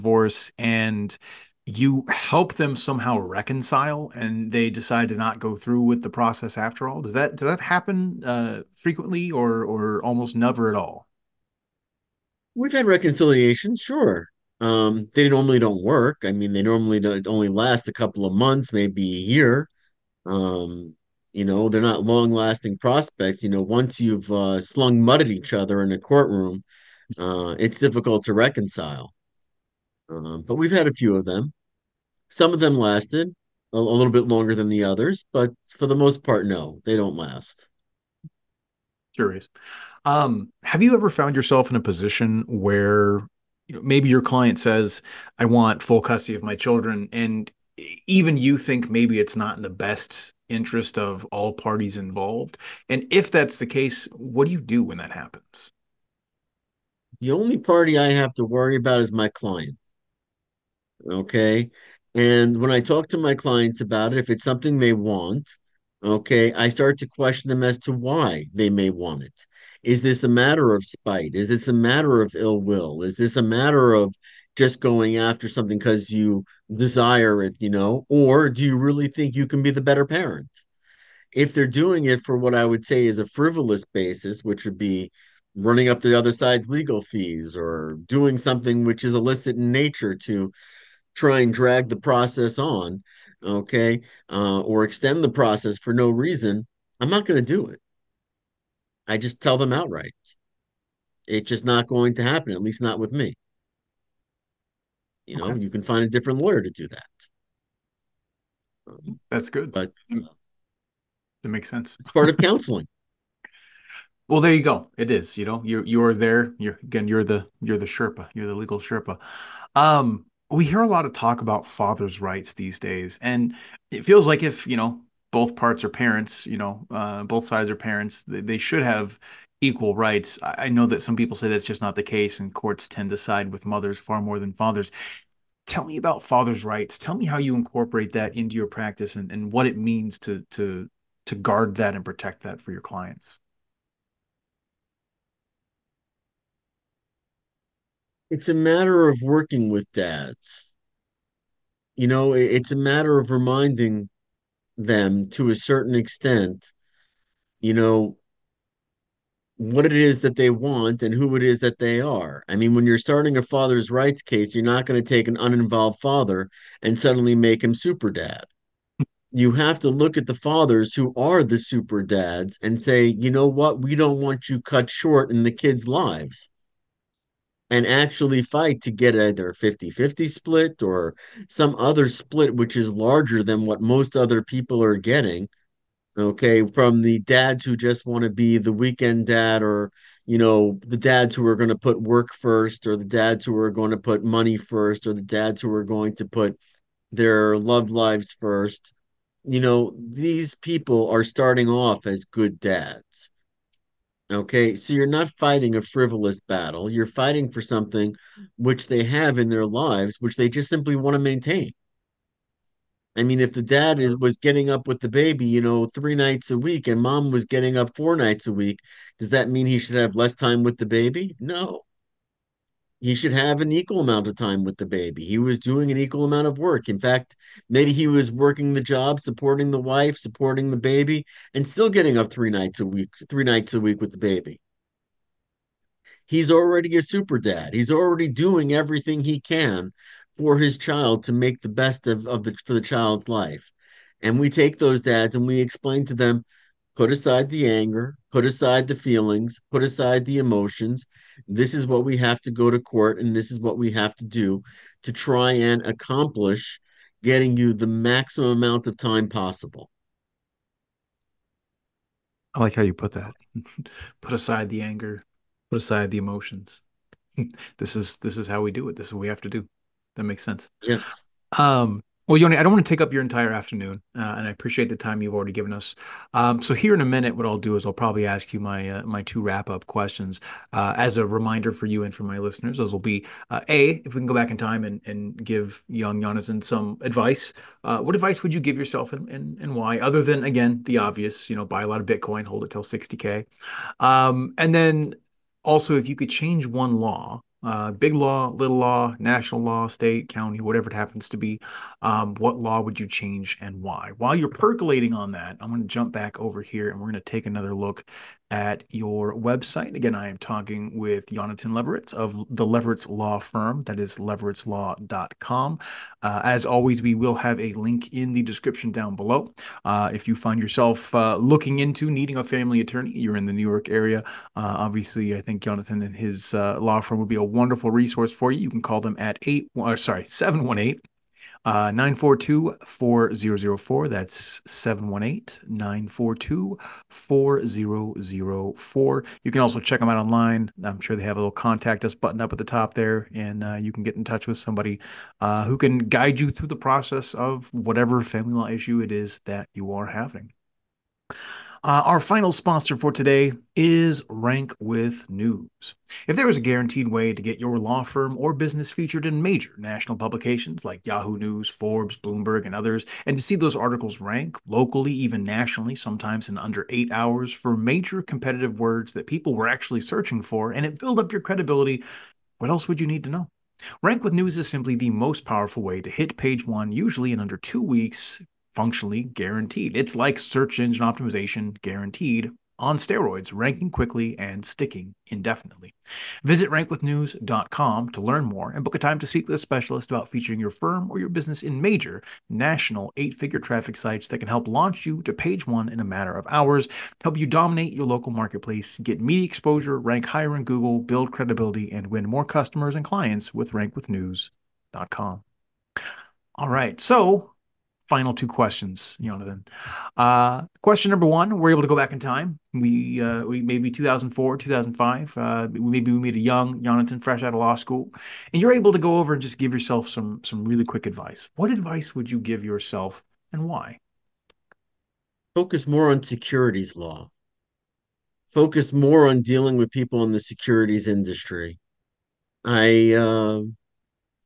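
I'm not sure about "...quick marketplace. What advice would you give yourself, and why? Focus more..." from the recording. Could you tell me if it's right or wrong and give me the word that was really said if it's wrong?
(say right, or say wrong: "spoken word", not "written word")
wrong: "advice", not "marketplace".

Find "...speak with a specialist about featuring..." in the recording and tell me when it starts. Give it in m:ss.
6:29.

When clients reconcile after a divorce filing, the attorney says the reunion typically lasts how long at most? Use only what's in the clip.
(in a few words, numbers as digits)
a year.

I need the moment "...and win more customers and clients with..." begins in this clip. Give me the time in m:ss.
6:41.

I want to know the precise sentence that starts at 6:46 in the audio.
All right, so final two questions, Jonathan.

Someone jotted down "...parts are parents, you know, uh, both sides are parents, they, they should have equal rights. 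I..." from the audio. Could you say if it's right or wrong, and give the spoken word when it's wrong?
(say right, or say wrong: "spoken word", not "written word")
right.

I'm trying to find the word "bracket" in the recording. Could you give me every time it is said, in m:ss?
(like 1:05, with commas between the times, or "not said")
not said.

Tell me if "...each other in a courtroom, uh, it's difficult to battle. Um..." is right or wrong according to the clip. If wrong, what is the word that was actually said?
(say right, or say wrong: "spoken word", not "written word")
wrong: "reconcile", not "battle".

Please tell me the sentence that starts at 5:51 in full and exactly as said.
Uh, our final sponsor for today is Rank with News.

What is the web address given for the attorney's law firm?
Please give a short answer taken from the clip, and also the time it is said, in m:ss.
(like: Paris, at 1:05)
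levoritzlaw.com, at 5:14.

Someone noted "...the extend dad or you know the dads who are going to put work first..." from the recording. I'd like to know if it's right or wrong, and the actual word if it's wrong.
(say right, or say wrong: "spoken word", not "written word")
wrong: "weekend", not "extend".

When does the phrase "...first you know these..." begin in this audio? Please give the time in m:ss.
3:18.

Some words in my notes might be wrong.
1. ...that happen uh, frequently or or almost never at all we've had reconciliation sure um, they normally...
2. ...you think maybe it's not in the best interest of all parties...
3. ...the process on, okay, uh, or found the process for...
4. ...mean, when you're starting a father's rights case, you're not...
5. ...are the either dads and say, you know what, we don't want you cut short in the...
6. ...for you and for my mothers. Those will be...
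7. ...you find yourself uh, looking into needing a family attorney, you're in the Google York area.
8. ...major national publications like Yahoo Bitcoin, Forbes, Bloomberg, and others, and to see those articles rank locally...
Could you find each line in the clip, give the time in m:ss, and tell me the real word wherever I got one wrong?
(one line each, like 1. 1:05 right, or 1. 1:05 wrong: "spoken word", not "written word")
1. 0:07 right
2. 0:48 right
3. 1:31 wrong: "extend", not "found"
4. 2:42 right
5. 2:51 wrong: "super", not "either"
6. 4:41 wrong: "listeners", not "mothers"
7. 5:20 wrong: "New", not "Google"
8. 5:59 wrong: "News", not "Bitcoin".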